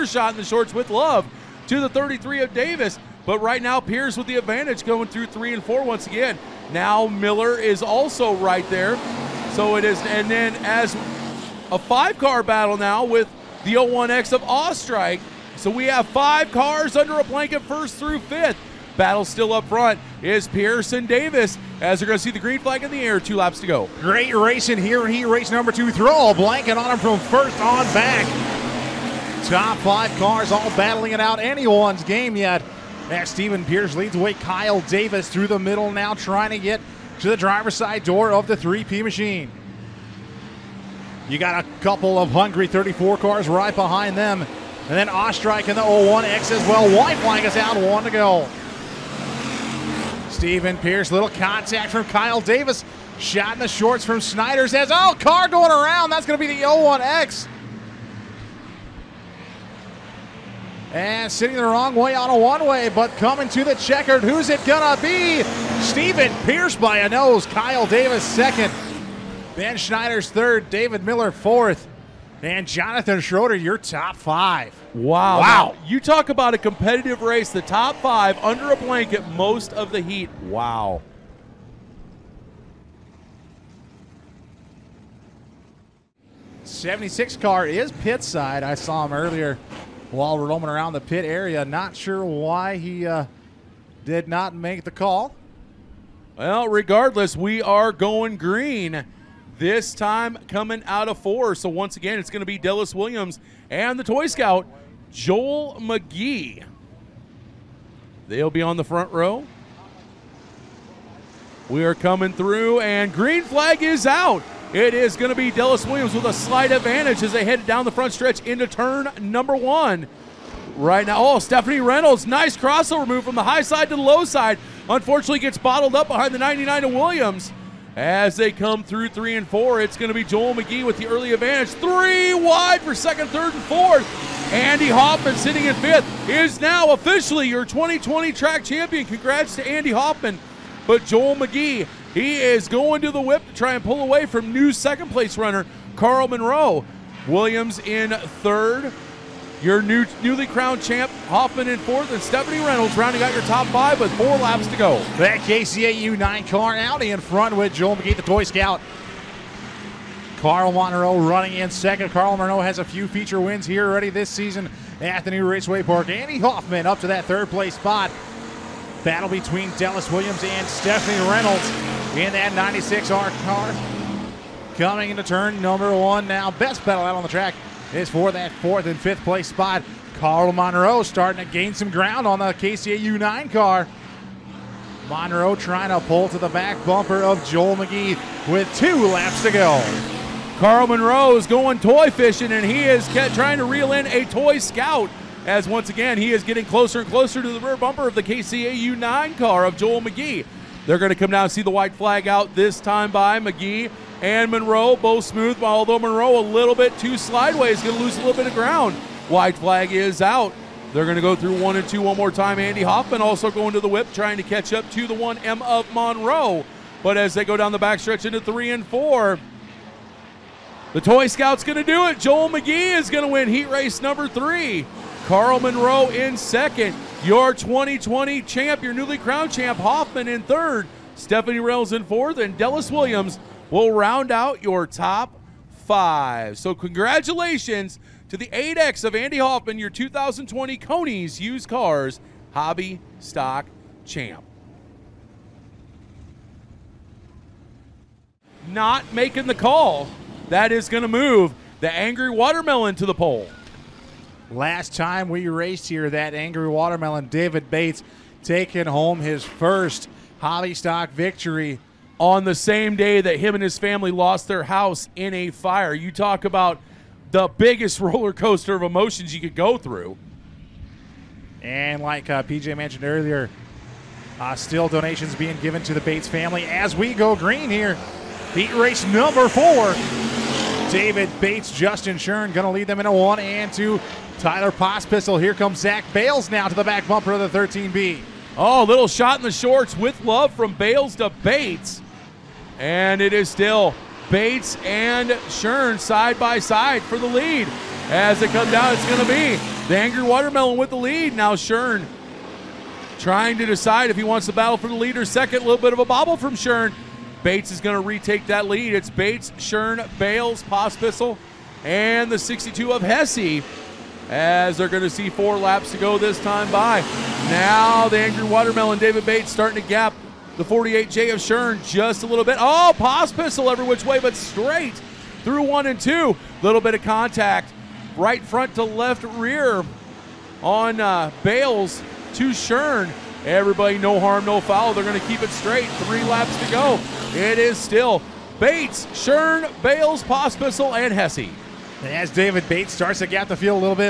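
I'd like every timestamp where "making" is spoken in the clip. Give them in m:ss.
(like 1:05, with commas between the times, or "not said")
4:09.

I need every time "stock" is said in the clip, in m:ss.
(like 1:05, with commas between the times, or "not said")
4:03, 4:20.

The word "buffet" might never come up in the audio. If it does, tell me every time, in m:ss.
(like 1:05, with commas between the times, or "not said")
not said.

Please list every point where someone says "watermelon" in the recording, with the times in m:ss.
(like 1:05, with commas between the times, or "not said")
4:12, 4:16, 5:00, 5:18.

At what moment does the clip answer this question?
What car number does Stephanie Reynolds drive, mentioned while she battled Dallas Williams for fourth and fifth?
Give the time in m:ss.
2:52.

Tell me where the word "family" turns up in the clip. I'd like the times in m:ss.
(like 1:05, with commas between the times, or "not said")
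4:23, 4:36.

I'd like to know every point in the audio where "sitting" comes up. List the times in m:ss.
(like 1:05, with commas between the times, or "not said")
1:01, 2:15.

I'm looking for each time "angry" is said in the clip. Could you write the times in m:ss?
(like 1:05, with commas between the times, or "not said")
4:11, 4:16, 4:59, 5:18.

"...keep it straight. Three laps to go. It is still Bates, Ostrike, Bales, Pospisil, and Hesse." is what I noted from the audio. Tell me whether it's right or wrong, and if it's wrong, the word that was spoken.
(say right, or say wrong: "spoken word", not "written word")
wrong: "Shern", not "Ostrike".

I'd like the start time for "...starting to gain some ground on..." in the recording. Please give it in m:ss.
3:01.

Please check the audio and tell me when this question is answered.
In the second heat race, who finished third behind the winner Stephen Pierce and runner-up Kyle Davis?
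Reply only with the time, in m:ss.
1:09.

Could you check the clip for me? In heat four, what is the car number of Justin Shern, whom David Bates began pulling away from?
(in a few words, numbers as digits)
48J.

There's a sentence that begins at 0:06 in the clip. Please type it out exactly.
Now Miller is also right there.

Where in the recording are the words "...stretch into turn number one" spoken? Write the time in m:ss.
1:58.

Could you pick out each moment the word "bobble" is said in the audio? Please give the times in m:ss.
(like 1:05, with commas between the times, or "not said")
5:06.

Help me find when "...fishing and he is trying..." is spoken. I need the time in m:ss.
3:12.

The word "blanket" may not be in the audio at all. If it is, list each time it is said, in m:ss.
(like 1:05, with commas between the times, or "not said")
0:17, 0:26, 1:18.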